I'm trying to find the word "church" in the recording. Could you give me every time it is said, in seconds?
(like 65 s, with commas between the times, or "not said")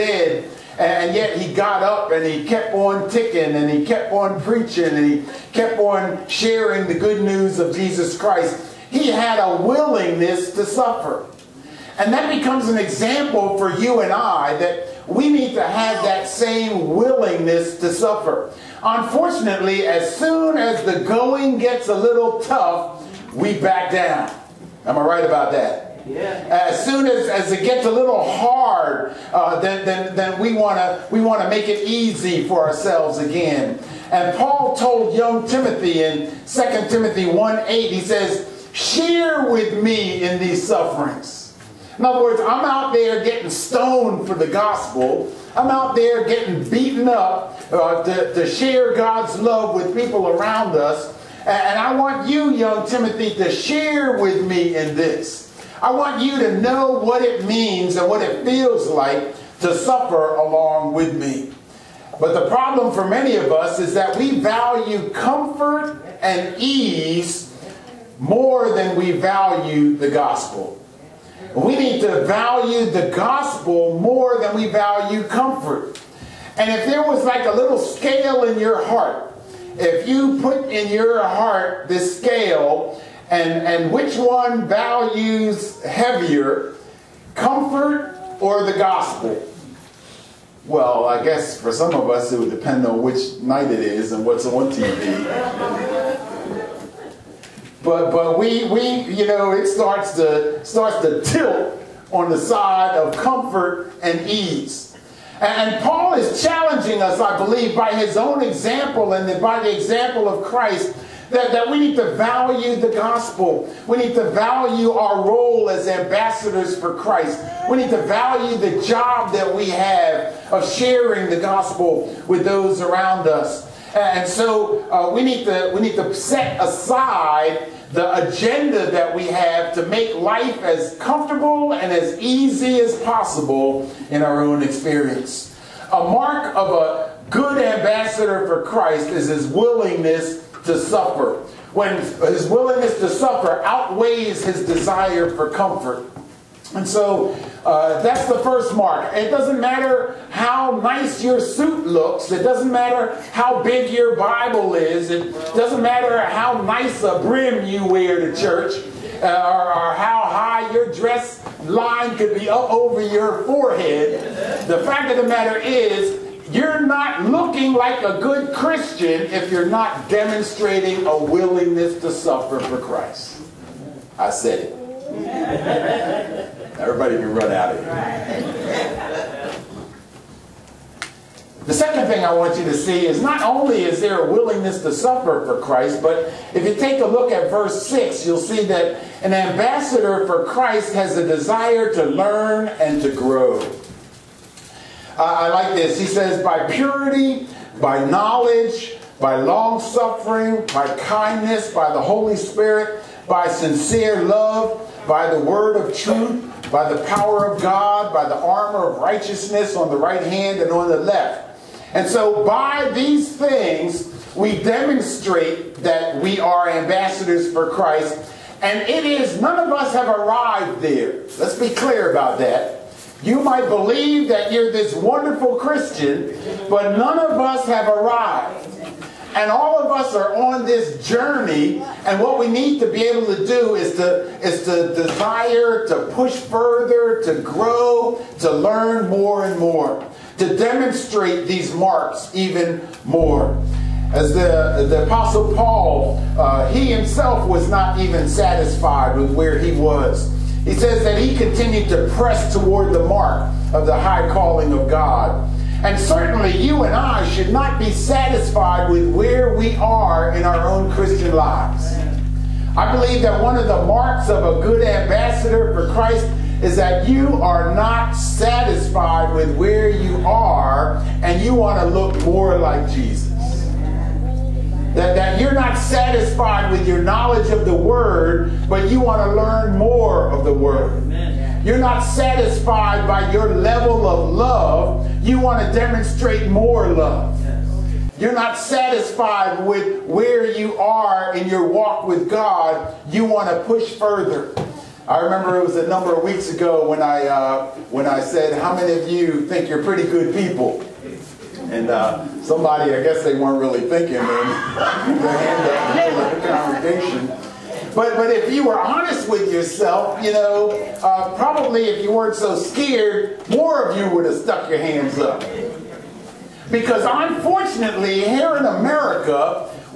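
158 s.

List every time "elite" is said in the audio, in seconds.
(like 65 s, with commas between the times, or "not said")
not said.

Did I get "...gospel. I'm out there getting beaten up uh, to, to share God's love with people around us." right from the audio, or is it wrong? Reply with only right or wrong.
right.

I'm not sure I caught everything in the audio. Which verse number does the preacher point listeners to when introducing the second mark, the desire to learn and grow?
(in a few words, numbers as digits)
verse 6.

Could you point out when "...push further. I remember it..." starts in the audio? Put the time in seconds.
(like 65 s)
293 s.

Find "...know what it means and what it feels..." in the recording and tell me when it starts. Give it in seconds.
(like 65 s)
56 s.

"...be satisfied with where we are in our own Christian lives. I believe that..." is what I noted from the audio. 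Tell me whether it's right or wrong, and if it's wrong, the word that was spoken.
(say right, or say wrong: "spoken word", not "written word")
right.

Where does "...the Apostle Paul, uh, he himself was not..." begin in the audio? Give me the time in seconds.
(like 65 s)
244 s.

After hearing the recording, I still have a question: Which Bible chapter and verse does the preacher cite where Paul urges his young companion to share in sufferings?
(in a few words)
2 Timothy 1:8.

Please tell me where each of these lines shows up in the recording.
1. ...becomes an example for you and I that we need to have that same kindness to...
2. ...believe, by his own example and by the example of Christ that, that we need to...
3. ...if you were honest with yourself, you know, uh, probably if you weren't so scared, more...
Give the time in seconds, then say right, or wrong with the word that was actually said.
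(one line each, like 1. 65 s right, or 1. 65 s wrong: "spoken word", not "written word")
1. 12 s wrong: "willingness", not "kindness"
2. 107 s right
3. 308 s right.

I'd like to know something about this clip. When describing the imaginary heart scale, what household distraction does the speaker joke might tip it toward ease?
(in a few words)
TV.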